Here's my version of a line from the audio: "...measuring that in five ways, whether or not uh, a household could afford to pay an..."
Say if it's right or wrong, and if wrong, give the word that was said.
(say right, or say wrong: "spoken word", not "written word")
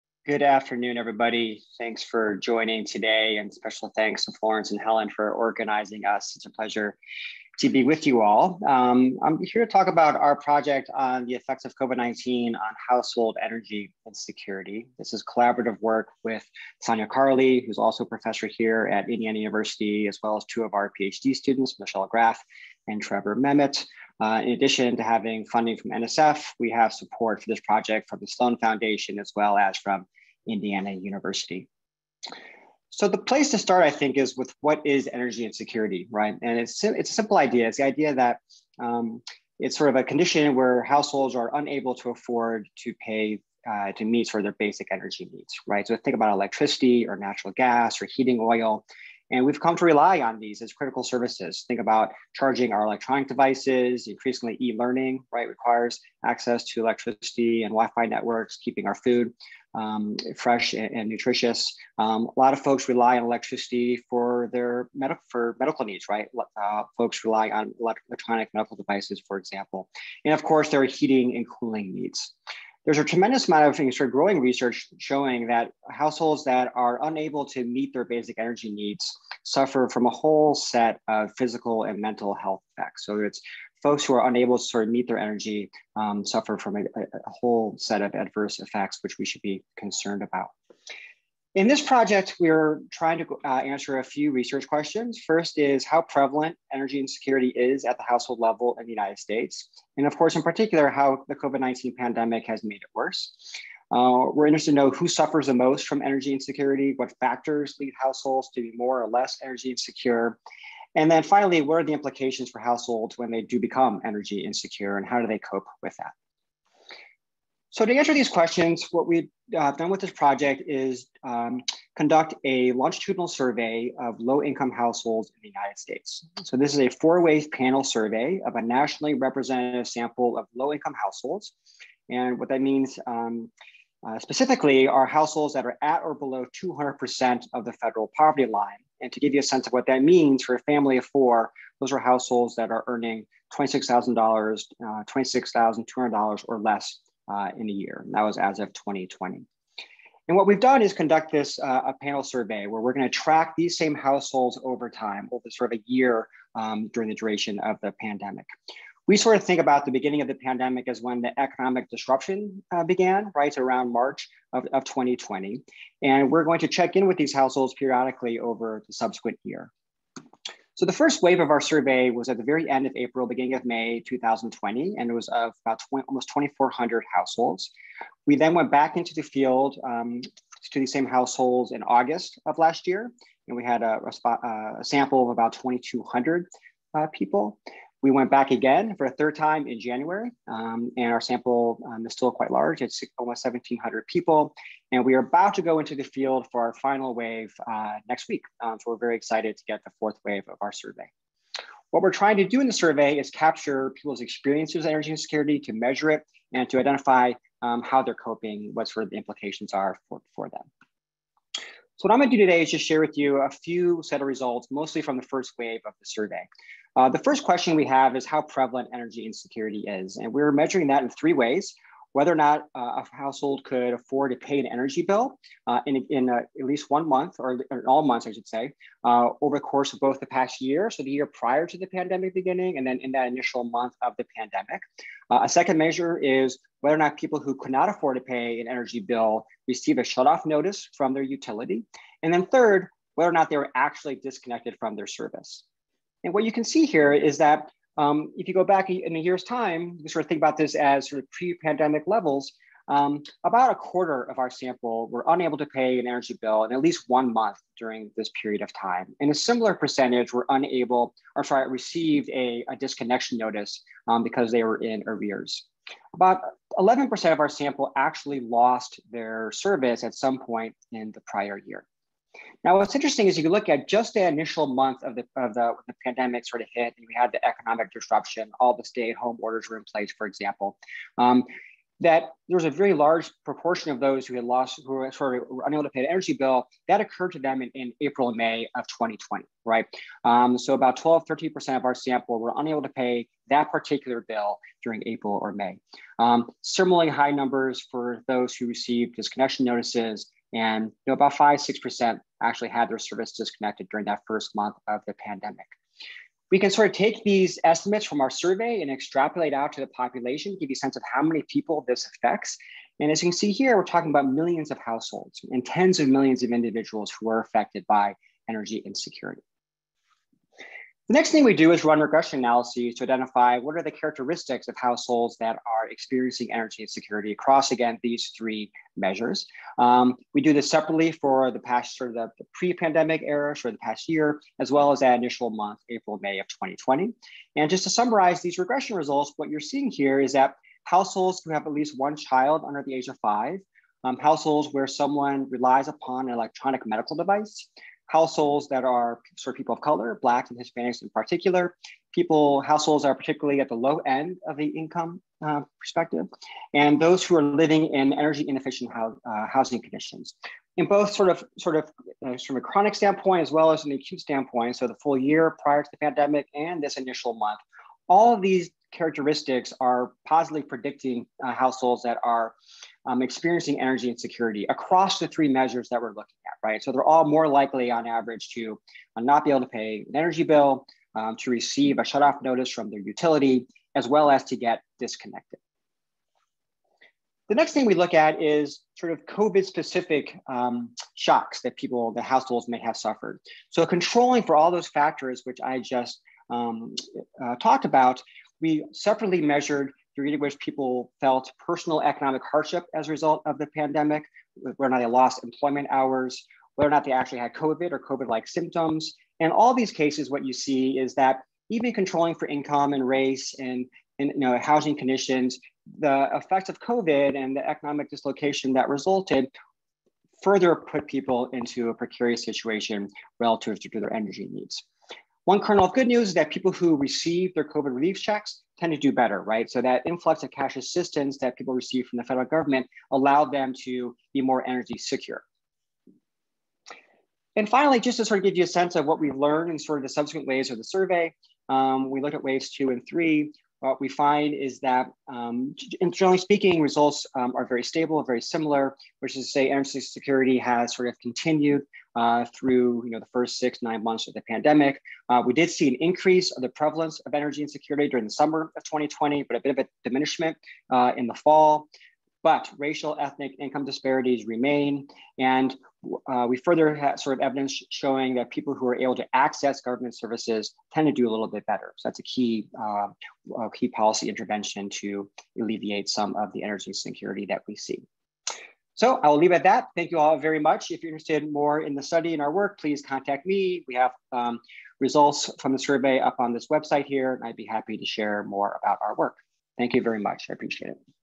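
wrong: "three", not "five".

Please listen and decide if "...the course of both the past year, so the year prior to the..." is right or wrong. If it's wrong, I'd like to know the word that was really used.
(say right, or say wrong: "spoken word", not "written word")
right.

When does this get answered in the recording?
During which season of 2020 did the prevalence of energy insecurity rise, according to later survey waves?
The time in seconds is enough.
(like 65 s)
458 s.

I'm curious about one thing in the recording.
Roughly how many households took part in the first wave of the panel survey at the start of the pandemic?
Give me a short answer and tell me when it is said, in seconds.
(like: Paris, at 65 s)
2,400, at 176 s.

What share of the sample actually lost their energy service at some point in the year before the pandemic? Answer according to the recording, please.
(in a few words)
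11%.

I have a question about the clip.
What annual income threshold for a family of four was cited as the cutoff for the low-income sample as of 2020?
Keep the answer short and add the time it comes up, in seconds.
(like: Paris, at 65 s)
$26,200, at 145 s.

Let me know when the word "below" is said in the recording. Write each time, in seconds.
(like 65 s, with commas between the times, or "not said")
136 s.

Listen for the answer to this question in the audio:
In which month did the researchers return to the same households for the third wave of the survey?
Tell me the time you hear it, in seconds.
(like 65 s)
189 s.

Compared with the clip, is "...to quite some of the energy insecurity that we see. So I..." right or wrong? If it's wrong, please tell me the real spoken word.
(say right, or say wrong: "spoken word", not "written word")
wrong: "alleviate", not "quite".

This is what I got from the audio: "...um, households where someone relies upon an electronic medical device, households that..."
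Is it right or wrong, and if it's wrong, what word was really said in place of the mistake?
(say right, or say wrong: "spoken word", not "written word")
right.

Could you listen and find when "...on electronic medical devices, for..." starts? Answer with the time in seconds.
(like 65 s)
67 s.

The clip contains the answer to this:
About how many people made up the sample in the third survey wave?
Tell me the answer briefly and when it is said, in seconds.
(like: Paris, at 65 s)
1,700, at 193 s.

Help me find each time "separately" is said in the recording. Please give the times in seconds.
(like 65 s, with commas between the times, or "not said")
330 s, 398 s.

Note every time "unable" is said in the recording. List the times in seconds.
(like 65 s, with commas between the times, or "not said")
41 s, 77 s, 84 s, 255 s, 260 s, 285 s, 292 s.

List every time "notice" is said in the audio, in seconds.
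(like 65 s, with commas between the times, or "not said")
240 s, 263 s, 299 s, 382 s.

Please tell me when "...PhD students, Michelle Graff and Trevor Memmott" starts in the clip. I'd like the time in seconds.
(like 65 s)
21 s.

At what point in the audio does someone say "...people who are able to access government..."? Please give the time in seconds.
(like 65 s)
468 s.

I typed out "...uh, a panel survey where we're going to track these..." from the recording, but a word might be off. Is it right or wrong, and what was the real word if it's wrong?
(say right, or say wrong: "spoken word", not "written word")
right.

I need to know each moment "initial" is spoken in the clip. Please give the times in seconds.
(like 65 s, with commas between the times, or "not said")
233 s, 274 s, 335 s, 366 s.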